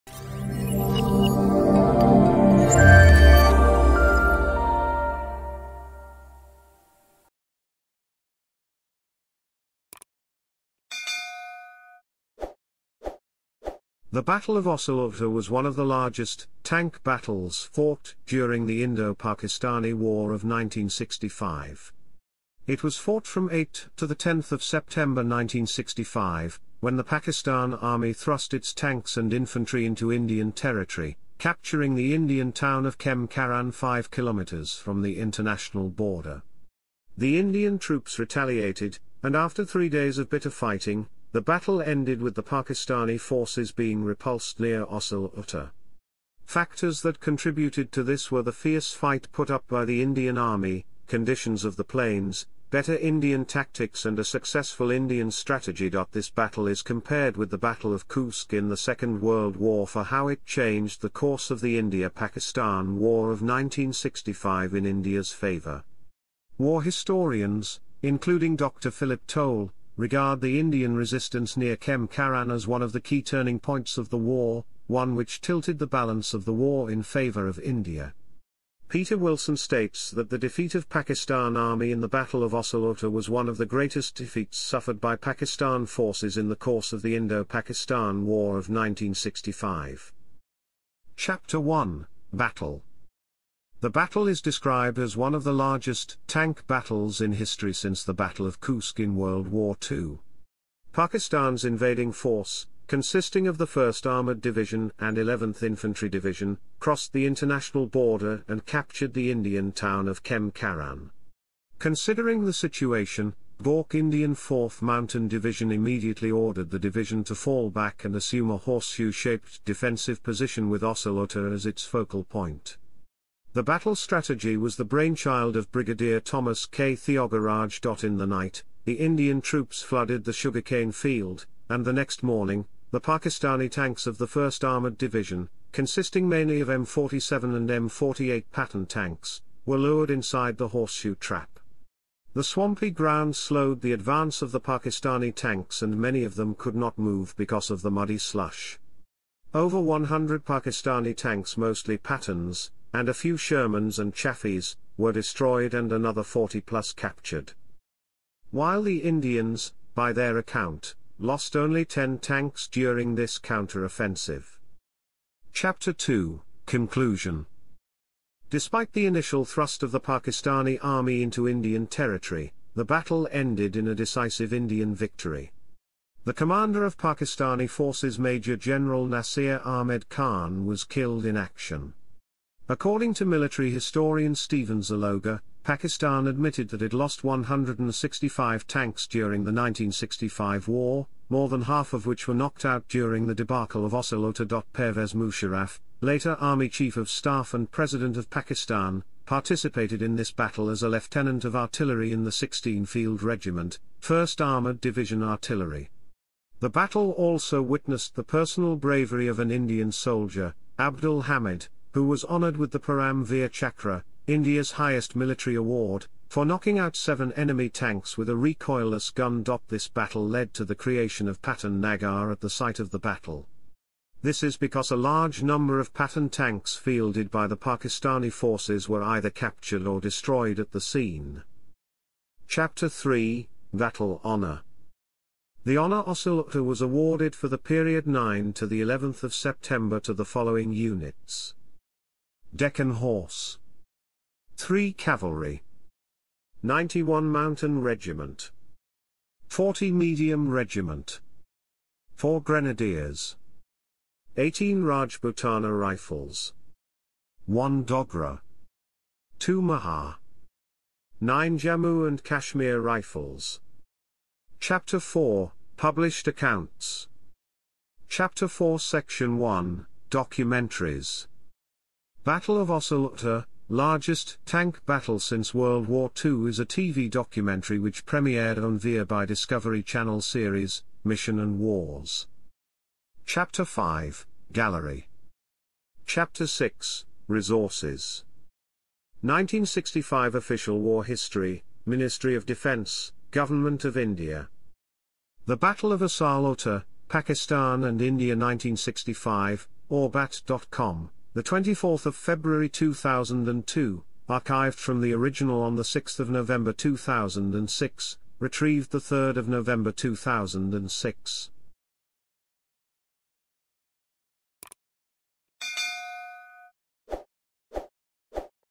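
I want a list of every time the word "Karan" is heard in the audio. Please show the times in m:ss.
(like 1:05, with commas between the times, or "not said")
0:33, 1:12, 1:50.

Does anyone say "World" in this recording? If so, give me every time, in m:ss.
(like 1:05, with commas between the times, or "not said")
0:59, 1:39, 4:35.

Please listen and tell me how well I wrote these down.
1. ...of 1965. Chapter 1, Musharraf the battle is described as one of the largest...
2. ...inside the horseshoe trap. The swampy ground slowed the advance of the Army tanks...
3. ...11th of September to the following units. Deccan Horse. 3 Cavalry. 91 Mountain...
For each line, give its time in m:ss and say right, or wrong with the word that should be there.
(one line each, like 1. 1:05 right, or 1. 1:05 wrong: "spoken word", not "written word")
1. 1:28 wrong: "Battle", not "Musharraf"
2. 2:20 wrong: "Pakistani", not "Army"
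3. 3:58 right.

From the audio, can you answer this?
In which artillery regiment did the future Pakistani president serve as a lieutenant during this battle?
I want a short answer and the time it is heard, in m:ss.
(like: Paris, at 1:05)
16 Field Regiment, at 3:22.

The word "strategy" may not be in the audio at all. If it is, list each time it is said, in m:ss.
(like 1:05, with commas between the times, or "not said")
0:55, 2:03.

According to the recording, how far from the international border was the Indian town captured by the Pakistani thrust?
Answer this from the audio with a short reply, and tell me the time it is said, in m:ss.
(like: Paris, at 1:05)
5 kilometers, at 0:33.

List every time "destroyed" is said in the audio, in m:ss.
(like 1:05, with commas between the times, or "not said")
2:35, 3:49.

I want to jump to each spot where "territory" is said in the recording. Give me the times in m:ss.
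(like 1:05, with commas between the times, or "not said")
0:30, 2:51.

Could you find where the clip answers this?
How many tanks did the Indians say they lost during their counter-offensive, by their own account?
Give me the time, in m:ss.
2:41.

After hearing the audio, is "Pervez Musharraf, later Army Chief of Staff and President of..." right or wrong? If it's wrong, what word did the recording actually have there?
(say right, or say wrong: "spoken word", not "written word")
right.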